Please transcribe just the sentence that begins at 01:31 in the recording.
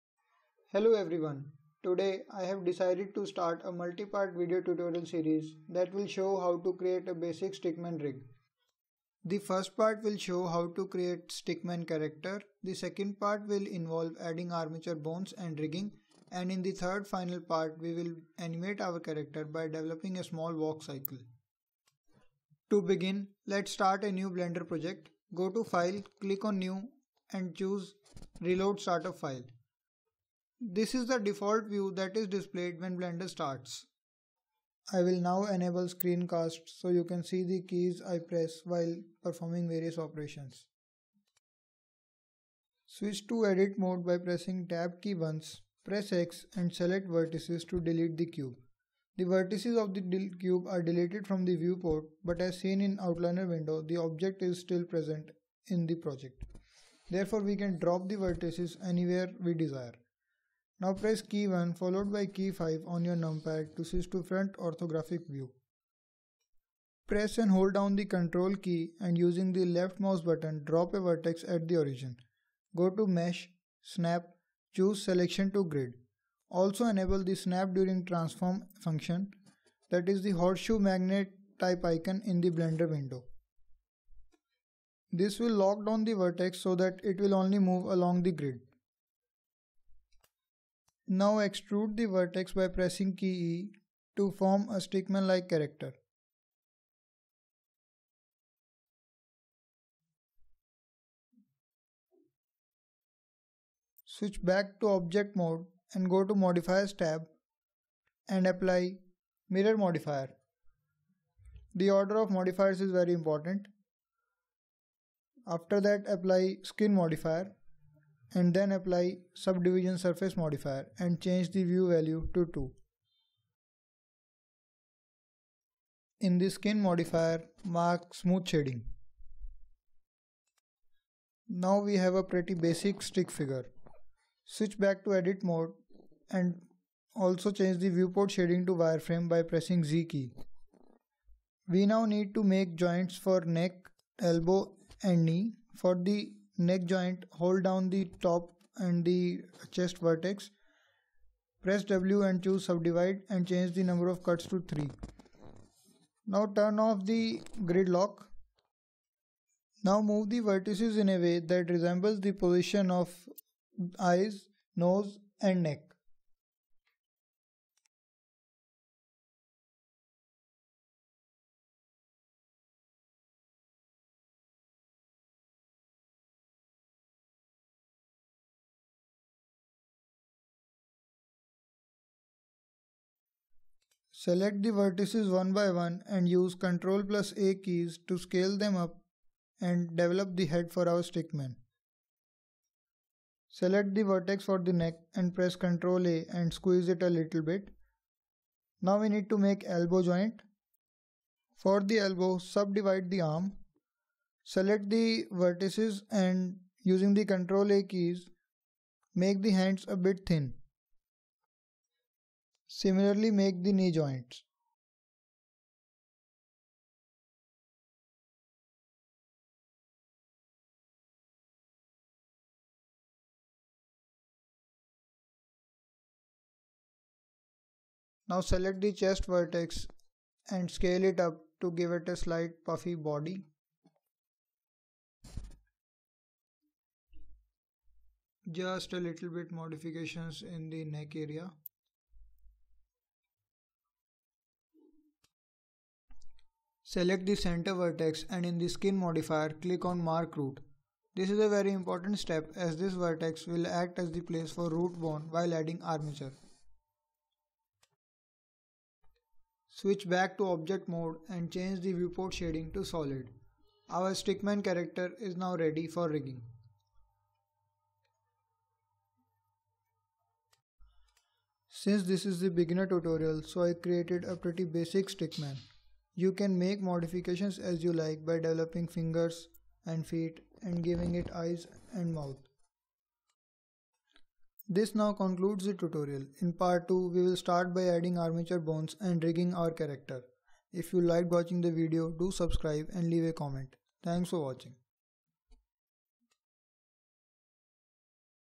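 Now extrude the vertex by pressing key E to form a stickman-like character.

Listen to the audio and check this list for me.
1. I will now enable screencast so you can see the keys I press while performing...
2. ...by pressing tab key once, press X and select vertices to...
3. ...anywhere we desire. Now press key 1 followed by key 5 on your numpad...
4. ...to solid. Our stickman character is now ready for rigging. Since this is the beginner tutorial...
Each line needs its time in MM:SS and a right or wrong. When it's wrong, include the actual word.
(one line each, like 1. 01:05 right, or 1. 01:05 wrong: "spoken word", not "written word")
1. 00:34 right
2. 00:44 right
3. 00:58 right
4. 04:22 right.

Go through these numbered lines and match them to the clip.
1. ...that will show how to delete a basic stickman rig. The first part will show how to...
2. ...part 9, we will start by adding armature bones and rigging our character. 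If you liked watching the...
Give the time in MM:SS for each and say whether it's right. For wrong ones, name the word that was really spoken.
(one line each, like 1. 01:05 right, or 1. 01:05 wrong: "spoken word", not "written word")
1. 00:05 wrong: "create", not "delete"
2. 04:46 wrong: "2", not "9".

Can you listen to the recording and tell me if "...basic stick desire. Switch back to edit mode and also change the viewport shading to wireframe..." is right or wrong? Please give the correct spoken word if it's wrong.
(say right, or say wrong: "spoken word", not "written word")
wrong: "figure", not "desire".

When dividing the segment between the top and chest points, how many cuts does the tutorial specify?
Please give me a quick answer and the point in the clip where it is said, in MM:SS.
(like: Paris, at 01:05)
3, at 02:34.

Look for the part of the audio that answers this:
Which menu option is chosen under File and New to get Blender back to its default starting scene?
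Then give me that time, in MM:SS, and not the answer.
00:28.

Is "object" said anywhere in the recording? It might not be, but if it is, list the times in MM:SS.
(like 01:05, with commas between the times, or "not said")
00:53, 01:44, 04:20.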